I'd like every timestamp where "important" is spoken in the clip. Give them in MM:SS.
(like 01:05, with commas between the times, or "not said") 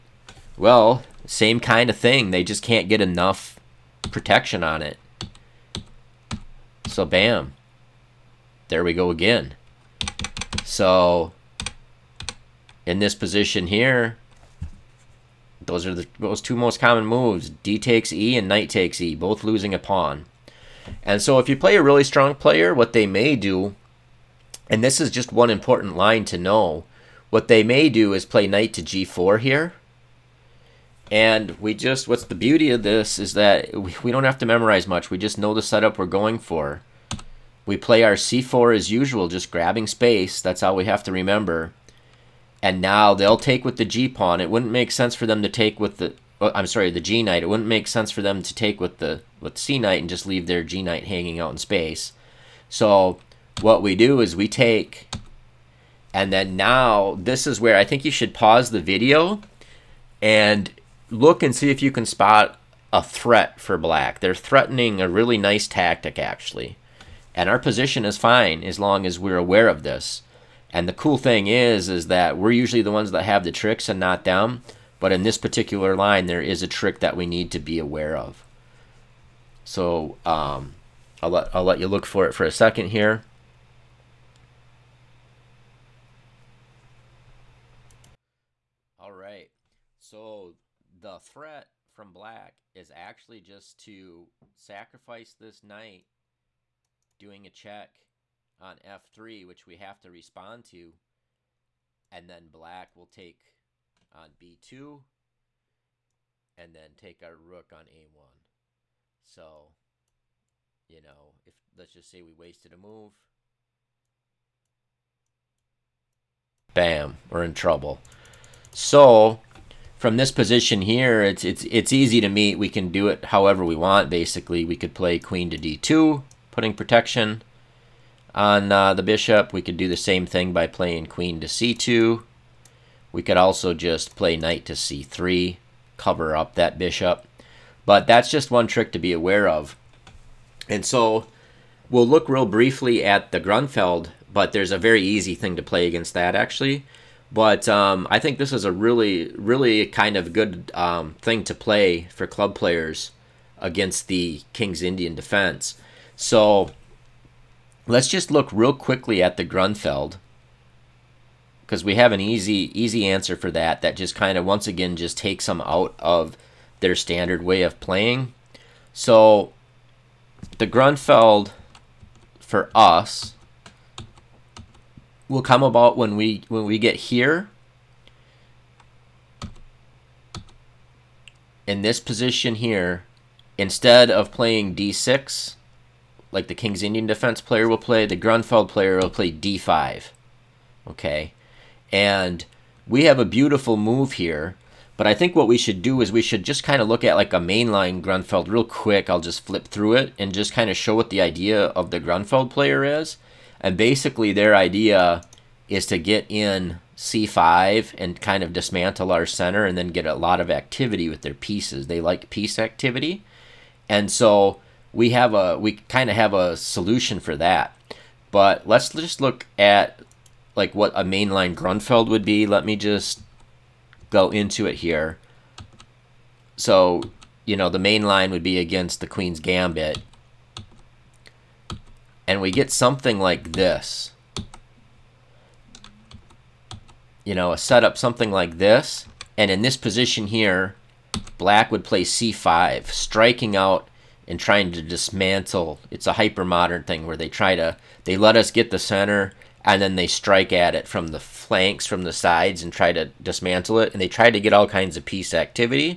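00:25.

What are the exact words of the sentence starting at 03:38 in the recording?
But let's just look at like what a mainline Grunfeld would be.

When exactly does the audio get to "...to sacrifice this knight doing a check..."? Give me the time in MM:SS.
01:33.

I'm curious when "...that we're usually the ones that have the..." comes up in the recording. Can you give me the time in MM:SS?
01:12.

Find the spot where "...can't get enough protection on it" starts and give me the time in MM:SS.
00:02.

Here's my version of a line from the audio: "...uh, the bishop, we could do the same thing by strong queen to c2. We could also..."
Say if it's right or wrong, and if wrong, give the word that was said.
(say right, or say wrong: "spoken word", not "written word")
wrong: "playing", not "strong".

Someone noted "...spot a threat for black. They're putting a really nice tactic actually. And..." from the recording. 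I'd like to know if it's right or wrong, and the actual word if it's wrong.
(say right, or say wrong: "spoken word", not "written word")
wrong: "threatening", not "putting".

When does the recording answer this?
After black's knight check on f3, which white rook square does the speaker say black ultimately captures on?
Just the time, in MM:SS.
01:47.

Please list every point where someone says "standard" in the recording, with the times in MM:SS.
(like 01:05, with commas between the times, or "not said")
02:46.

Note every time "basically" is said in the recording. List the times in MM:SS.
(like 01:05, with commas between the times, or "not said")
02:04, 03:23.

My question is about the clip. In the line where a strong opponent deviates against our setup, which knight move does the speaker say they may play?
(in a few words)
Knight to g4.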